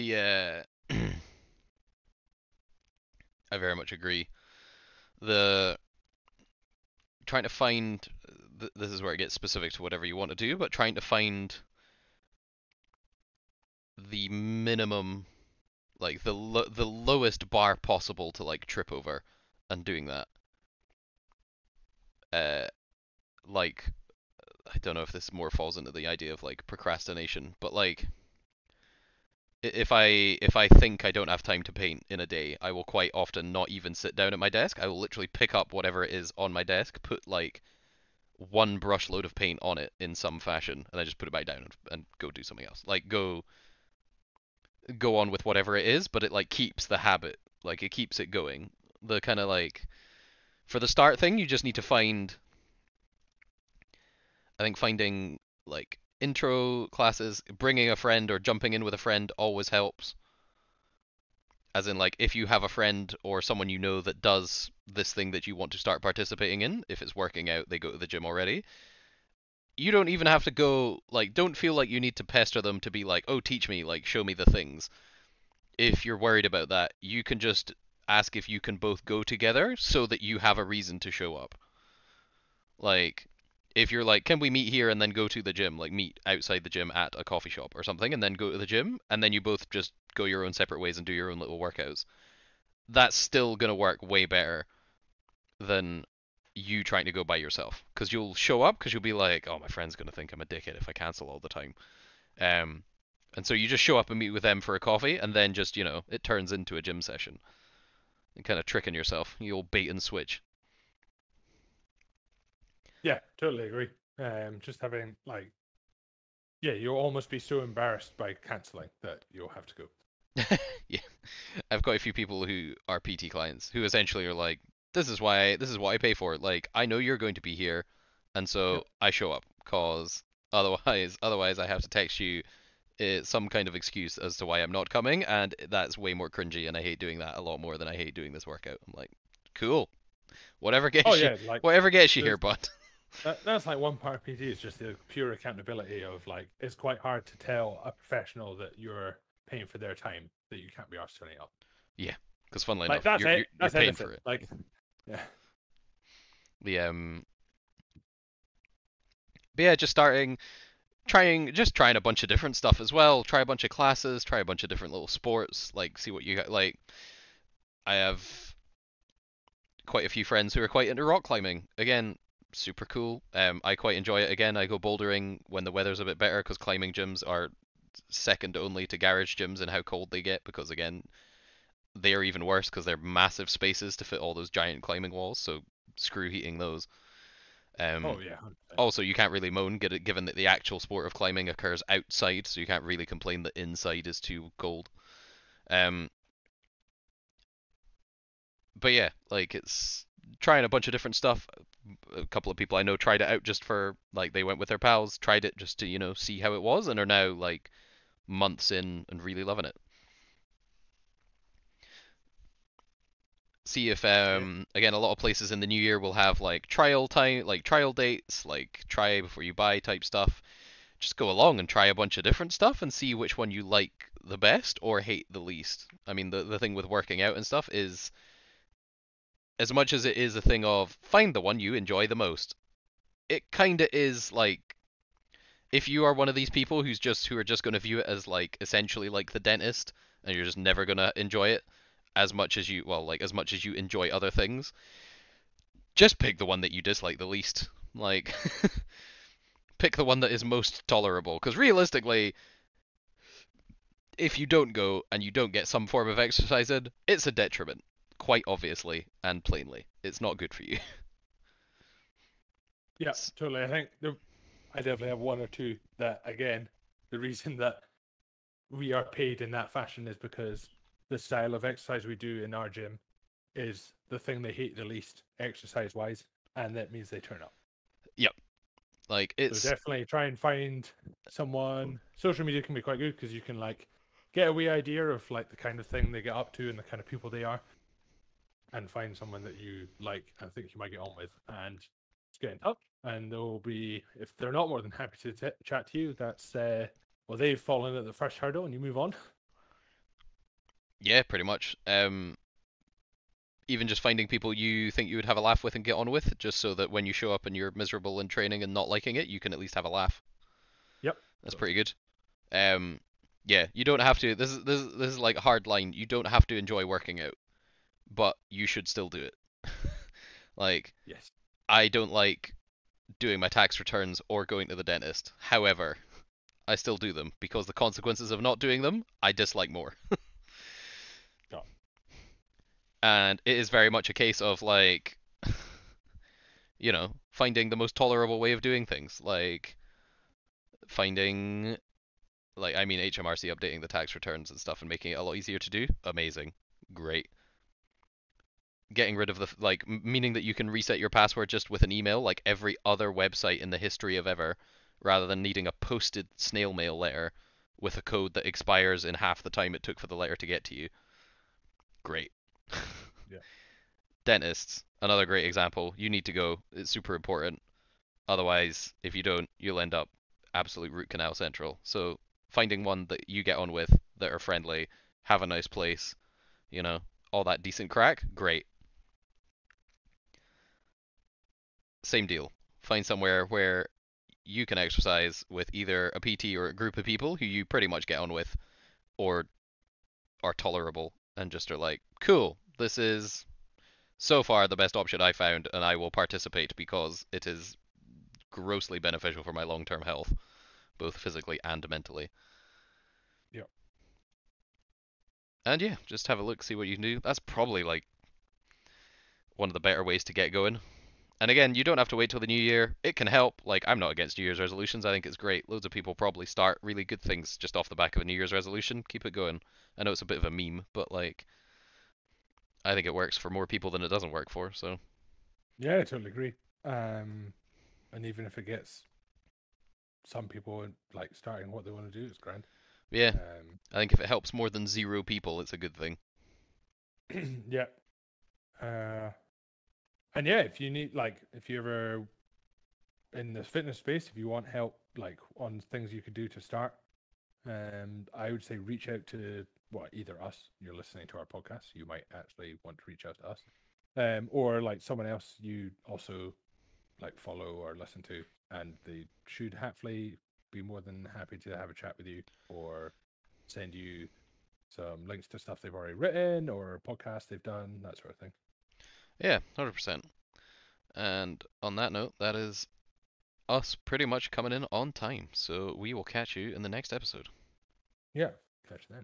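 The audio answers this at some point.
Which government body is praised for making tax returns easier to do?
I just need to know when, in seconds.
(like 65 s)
342 s.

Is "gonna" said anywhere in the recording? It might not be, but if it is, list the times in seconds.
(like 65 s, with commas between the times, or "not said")
93 s, 99 s.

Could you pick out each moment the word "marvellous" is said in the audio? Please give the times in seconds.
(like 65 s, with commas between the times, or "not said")
not said.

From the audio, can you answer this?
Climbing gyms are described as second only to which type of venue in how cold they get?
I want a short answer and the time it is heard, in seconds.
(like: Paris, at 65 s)
garage gyms, at 178 s.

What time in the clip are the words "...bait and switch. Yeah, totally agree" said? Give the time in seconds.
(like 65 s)
109 s.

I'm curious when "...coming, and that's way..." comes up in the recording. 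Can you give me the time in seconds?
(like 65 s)
134 s.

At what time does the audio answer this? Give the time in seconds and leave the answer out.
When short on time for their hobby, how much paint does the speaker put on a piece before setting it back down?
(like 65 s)
38 s.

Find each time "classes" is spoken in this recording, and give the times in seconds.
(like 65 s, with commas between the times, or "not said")
56 s, 163 s.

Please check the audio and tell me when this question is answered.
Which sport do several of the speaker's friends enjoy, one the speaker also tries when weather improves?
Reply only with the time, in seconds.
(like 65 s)
171 s.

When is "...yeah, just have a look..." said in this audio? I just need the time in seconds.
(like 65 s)
405 s.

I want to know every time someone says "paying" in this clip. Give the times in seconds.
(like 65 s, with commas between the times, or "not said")
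149 s, 153 s.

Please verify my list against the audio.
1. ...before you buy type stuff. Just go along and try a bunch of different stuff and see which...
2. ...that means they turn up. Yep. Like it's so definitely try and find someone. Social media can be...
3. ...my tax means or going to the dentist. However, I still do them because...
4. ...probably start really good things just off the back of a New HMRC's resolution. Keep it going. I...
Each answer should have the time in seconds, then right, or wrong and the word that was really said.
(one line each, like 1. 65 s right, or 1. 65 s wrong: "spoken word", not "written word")
1. 219 s right
2. 276 s right
3. 323 s wrong: "returns", not "means"
4. 416 s wrong: "Year", not "HMRC".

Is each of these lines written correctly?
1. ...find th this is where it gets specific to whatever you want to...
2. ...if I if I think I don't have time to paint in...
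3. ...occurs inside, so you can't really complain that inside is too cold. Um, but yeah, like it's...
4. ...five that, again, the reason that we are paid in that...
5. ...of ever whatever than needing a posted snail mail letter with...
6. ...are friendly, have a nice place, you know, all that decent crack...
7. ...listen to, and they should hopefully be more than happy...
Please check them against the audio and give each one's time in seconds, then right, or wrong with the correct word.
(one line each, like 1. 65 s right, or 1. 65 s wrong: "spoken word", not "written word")
1. 7 s right
2. 29 s right
3. 191 s wrong: "outside", not "inside"
4. 265 s wrong: "two", not "five"
5. 354 s wrong: "rather", not "whatever"
6. 374 s right
7. 457 s right.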